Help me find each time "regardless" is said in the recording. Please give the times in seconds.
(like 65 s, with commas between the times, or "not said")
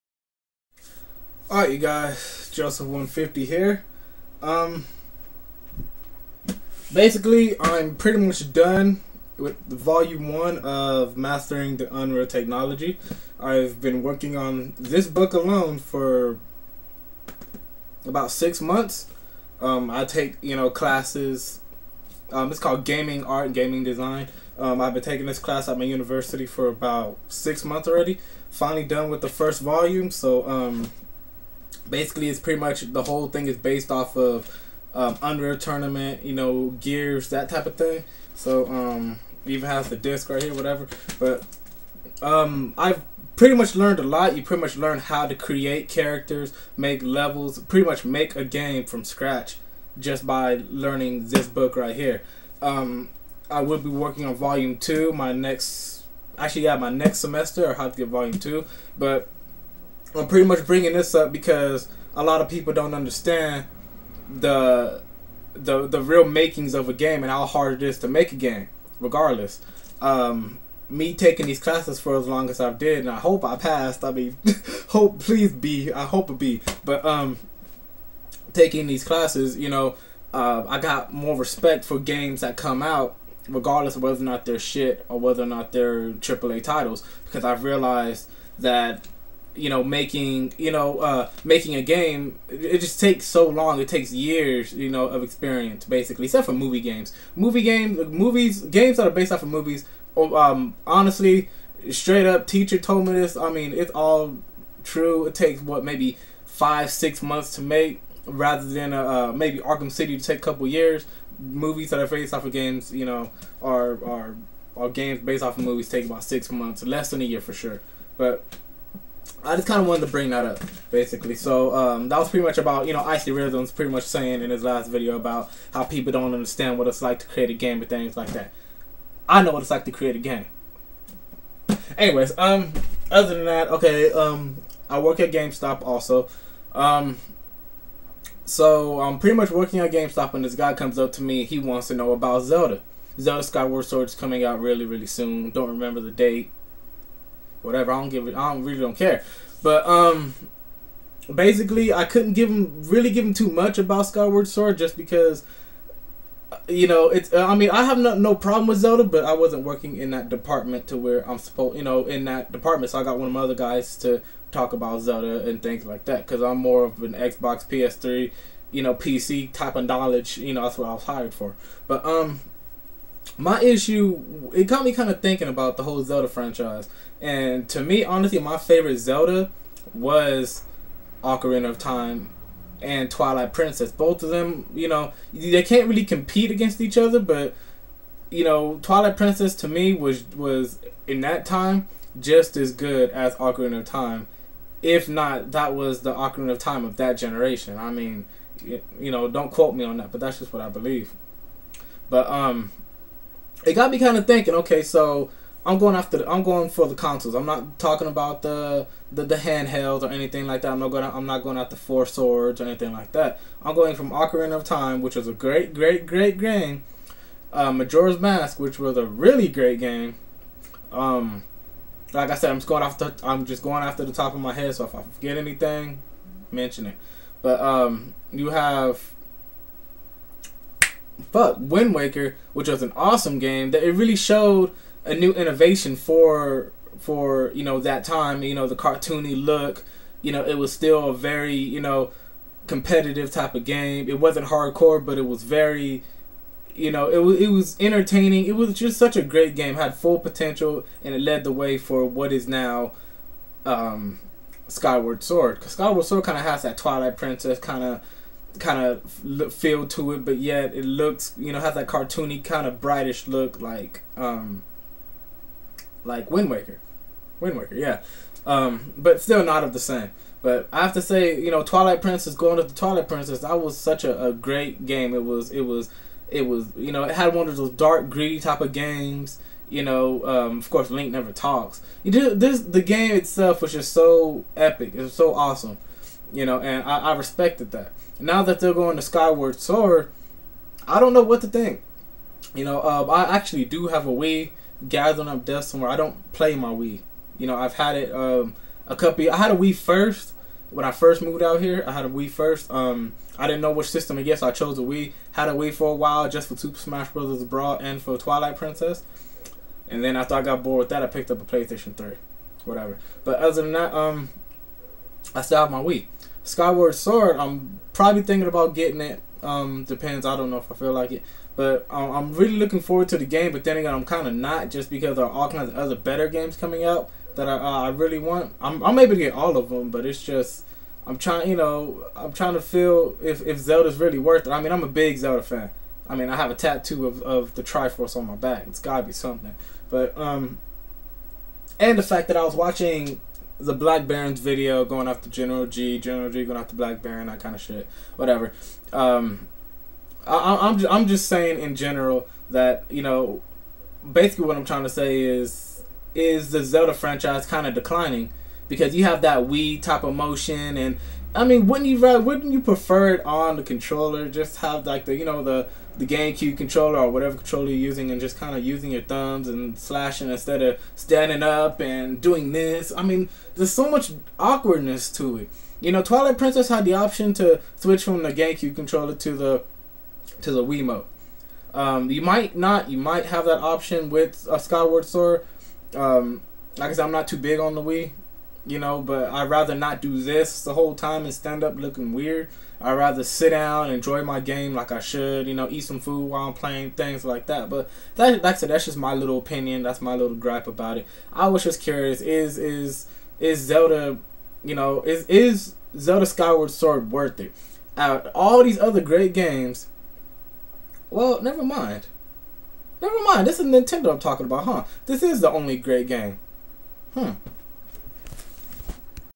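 68 s, 83 s.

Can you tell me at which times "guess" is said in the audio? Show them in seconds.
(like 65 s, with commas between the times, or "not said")
304 s.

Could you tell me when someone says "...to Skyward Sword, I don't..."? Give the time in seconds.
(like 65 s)
288 s.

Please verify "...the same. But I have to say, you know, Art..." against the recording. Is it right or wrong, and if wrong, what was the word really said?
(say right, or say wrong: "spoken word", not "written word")
wrong: "Twilight", not "Art".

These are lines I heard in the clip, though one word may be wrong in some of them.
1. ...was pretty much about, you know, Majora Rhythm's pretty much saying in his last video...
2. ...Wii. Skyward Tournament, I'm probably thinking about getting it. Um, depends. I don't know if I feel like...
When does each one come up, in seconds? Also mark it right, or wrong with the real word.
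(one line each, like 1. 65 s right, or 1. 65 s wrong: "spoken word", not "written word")
1. 122 s wrong: "Icy", not "Majora"
2. 315 s wrong: "Sword", not "Tournament".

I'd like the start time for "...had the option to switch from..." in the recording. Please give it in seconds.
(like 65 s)
376 s.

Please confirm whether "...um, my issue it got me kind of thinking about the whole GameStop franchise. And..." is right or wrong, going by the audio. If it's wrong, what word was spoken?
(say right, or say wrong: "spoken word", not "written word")
wrong: "Zelda", not "GameStop".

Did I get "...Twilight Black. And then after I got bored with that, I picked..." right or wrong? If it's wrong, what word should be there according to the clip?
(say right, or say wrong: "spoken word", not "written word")
wrong: "Princess", not "Black".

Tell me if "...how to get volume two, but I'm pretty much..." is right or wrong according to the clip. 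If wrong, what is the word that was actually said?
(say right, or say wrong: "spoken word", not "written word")
right.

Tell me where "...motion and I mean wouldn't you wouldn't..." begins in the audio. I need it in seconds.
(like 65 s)
360 s.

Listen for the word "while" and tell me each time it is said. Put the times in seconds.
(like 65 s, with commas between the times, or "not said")
305 s, 396 s.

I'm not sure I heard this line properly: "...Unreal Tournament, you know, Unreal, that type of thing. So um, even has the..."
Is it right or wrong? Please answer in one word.
wrong.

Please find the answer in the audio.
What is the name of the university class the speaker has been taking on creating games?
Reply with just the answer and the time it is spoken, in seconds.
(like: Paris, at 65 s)
Gaming Art and Gaming Design, at 22 s.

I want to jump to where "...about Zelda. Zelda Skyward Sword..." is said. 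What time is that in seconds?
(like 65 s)
142 s.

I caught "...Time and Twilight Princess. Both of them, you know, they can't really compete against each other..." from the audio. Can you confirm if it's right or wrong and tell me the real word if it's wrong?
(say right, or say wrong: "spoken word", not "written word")
right.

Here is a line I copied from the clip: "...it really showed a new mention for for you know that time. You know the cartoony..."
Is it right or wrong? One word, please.
wrong.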